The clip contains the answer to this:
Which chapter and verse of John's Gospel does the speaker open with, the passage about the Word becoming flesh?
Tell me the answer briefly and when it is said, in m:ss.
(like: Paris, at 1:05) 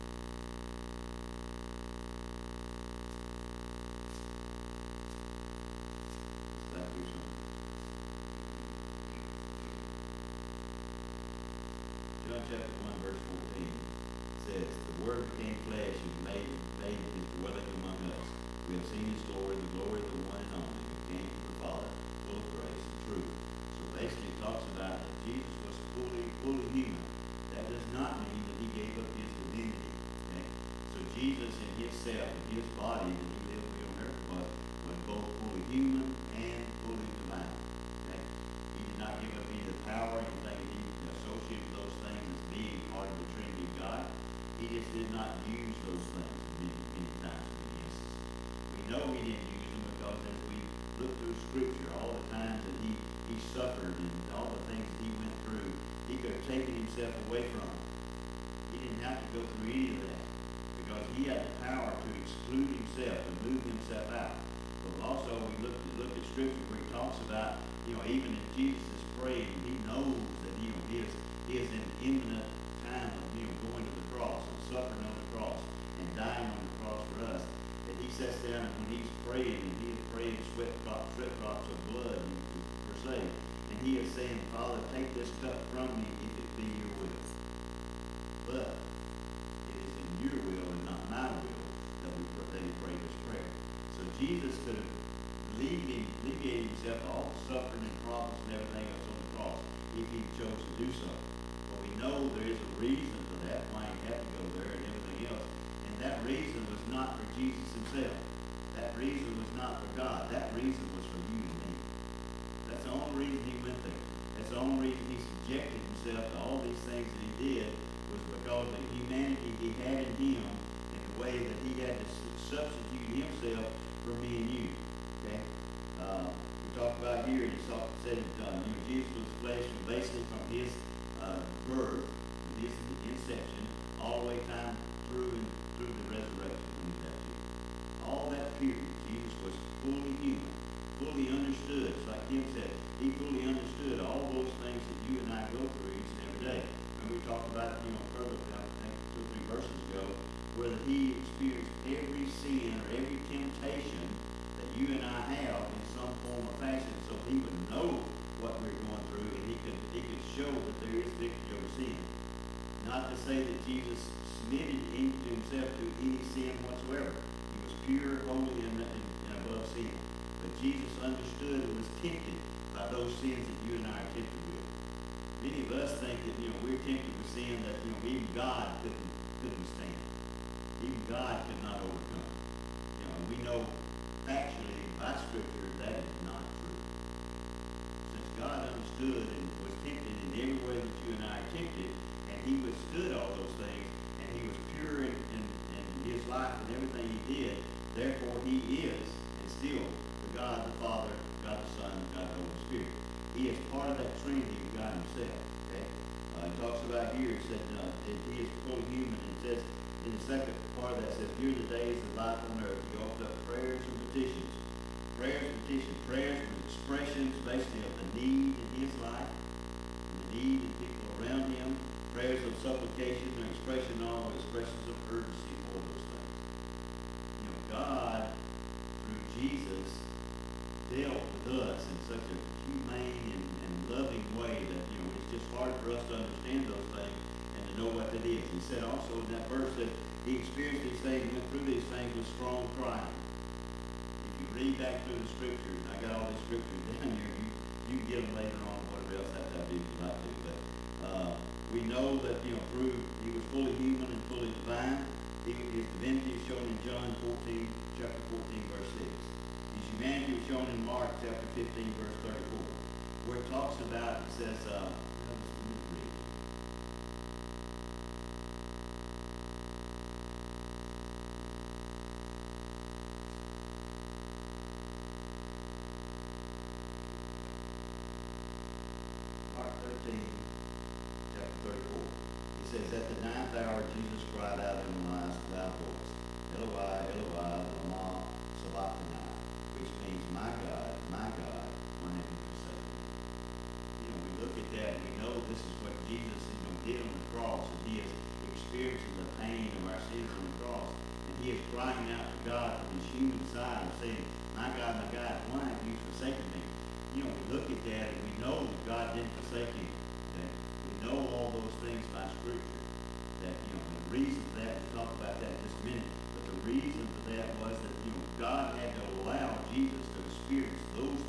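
Chapter 1, verse 14, at 0:12.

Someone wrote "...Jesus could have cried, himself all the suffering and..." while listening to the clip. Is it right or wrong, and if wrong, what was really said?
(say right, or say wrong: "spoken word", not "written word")
wrong: "alleviated", not "cried".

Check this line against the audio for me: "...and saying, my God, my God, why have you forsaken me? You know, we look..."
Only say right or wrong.
right.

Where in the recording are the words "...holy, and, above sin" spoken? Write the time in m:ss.
2:48.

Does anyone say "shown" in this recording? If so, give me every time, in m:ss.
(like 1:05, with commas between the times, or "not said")
4:16, 4:20.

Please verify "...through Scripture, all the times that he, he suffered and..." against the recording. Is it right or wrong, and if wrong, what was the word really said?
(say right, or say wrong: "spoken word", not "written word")
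right.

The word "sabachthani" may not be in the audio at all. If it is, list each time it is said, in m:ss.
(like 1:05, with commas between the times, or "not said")
4:48.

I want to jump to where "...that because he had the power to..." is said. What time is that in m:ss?
1:00.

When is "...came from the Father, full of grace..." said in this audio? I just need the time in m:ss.
0:21.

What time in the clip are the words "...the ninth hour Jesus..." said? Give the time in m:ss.
4:43.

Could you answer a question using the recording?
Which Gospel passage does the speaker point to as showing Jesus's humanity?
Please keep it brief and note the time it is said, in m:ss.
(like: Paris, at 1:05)
Mark 15:34, at 4:20.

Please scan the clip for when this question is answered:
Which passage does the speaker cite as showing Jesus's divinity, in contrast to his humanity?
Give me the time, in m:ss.
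4:16.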